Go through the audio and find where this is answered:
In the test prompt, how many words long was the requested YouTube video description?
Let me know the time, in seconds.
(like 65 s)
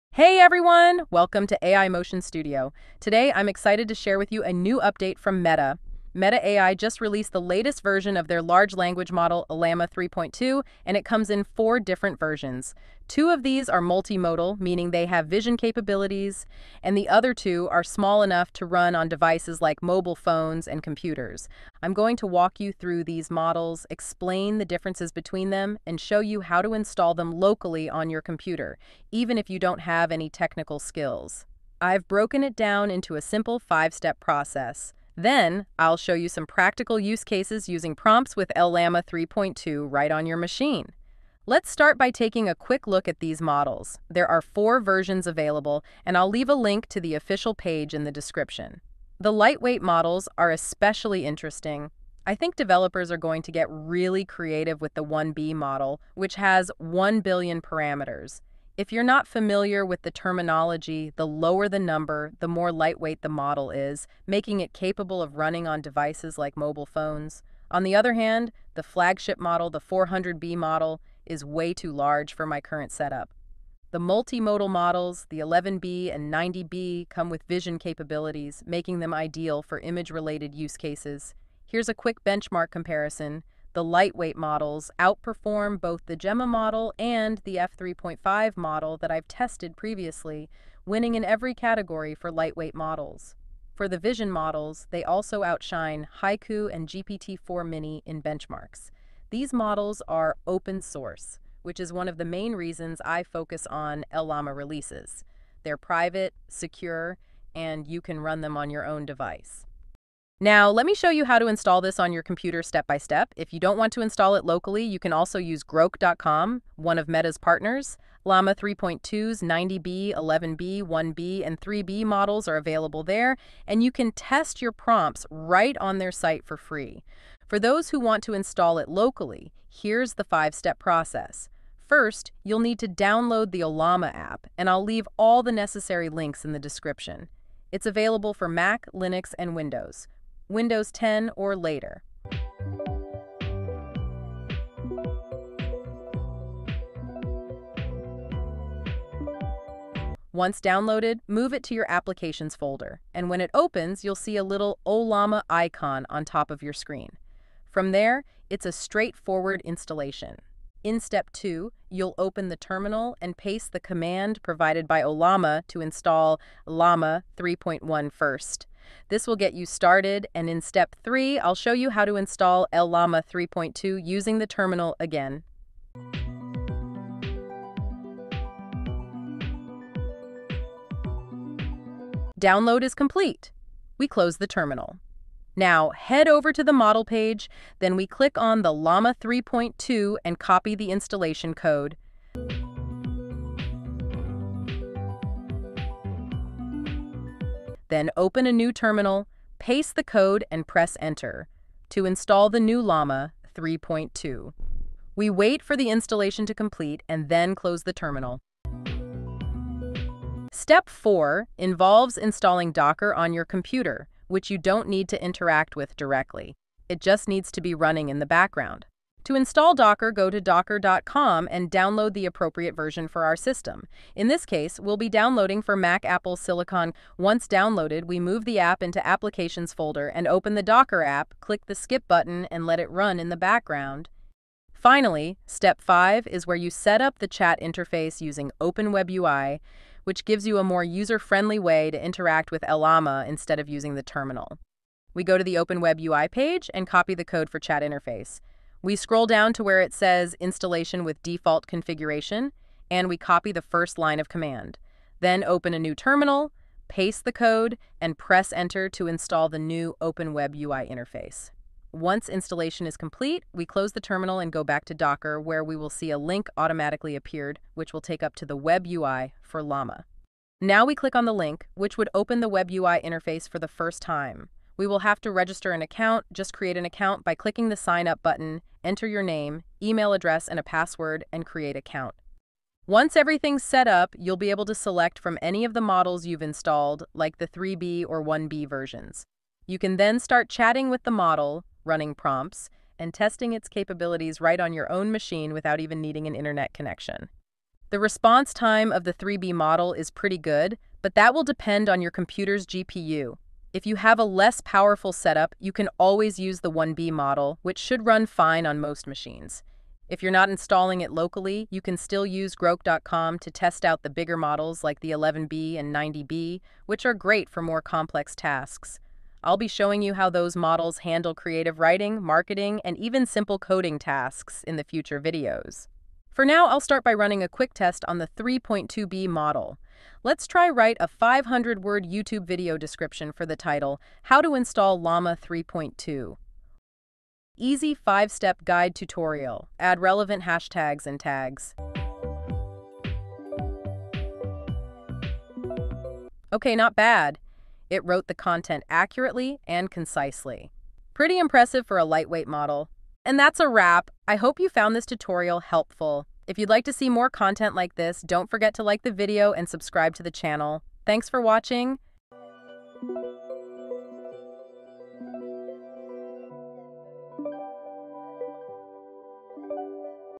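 331 s.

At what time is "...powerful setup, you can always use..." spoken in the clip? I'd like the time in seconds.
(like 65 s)
304 s.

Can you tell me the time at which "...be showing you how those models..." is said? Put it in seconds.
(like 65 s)
319 s.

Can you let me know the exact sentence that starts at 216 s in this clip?
It just needs to be running in the background.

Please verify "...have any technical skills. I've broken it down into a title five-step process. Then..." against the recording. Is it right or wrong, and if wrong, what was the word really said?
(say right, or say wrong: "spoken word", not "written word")
wrong: "simple", not "title".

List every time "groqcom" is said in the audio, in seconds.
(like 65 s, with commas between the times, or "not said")
115 s, 312 s.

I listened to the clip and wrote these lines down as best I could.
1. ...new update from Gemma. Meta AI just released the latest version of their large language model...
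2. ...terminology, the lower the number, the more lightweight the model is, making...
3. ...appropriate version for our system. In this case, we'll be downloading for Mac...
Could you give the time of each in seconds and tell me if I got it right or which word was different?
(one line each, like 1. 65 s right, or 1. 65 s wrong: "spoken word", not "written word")
1. 4 s wrong: "Meta", not "Gemma"
2. 60 s right
3. 222 s right.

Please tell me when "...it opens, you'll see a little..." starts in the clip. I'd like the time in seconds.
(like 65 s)
153 s.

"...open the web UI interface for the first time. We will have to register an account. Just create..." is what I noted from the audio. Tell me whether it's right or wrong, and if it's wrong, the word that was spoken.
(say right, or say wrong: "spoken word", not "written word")
right.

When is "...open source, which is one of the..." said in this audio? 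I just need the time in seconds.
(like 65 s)
100 s.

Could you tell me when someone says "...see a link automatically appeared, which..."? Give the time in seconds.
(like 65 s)
265 s.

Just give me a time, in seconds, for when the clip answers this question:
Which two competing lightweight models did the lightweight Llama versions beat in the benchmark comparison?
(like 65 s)
86 s.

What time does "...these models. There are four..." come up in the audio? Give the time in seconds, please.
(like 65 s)
43 s.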